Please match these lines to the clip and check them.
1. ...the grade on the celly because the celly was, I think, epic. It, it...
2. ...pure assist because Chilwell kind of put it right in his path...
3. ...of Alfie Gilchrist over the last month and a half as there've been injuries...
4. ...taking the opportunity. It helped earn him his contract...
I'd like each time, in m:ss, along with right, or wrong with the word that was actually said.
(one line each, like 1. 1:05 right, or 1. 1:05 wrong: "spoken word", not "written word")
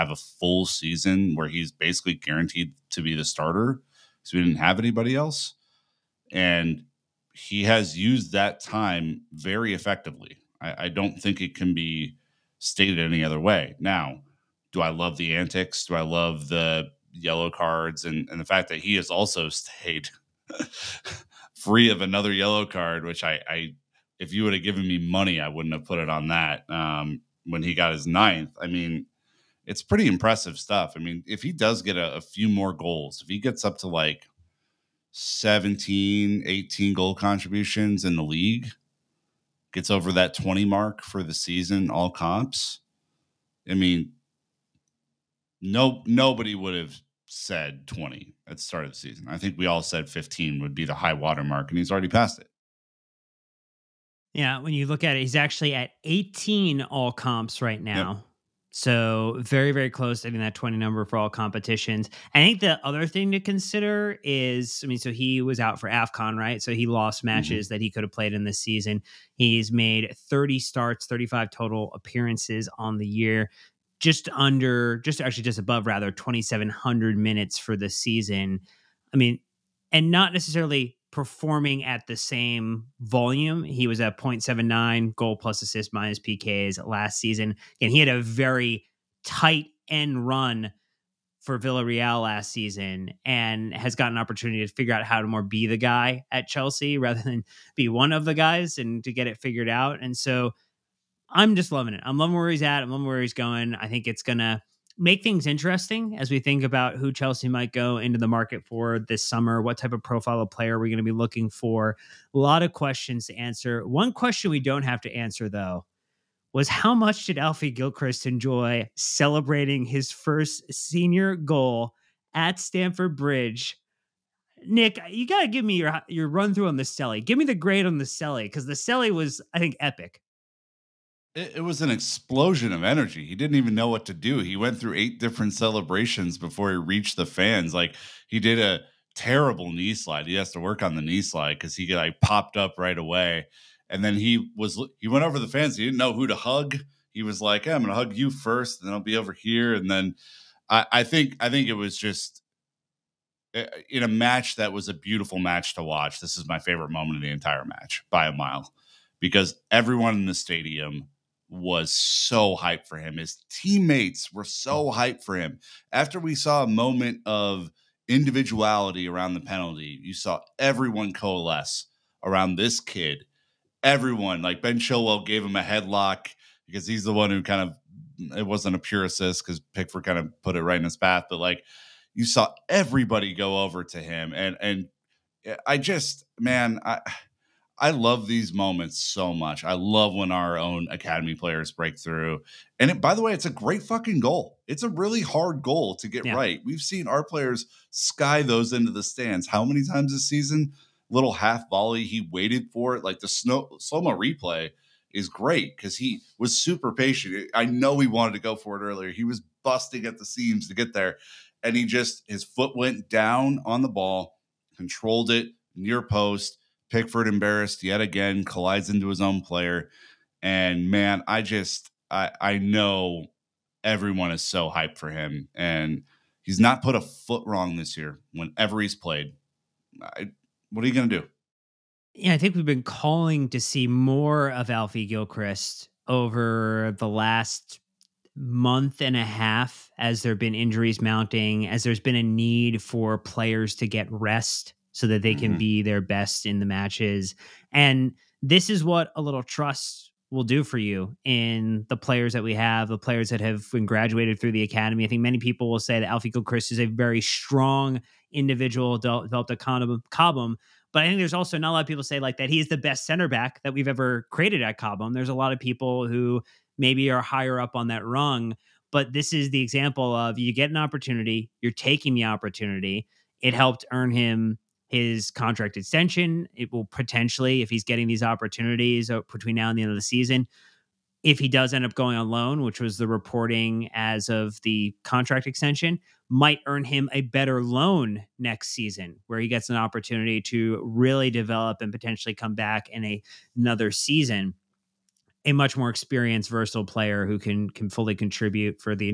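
1. 2:07 right
2. 2:58 wrong: "Pickford", not "Chilwell"
3. 3:54 right
4. 4:31 right.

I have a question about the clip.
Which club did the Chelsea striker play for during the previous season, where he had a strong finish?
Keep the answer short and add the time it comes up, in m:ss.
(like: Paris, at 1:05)
Villarreal, at 1:31.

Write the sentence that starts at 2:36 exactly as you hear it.
This is my favorite moment of the entire match by a mile because everyone in the stadium was so hyped for him.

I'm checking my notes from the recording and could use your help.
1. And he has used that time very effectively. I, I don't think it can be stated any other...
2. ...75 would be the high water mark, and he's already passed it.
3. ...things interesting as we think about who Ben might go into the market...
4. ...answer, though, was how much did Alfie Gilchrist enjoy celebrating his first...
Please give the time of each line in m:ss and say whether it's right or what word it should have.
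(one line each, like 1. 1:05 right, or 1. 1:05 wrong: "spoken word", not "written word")
1. 0:06 right
2. 0:50 wrong: "15", not "75"
3. 1:45 wrong: "Chelsea", not "Ben"
4. 1:55 right.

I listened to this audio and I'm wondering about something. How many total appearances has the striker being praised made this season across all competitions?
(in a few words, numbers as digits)
35.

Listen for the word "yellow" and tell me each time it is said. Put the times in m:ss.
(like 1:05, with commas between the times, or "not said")
0:17, 0:22.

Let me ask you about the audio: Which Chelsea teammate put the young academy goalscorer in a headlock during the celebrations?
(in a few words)
Ben Chilwell.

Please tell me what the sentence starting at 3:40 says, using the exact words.
And man, I just I I know everyone is so hyped for him.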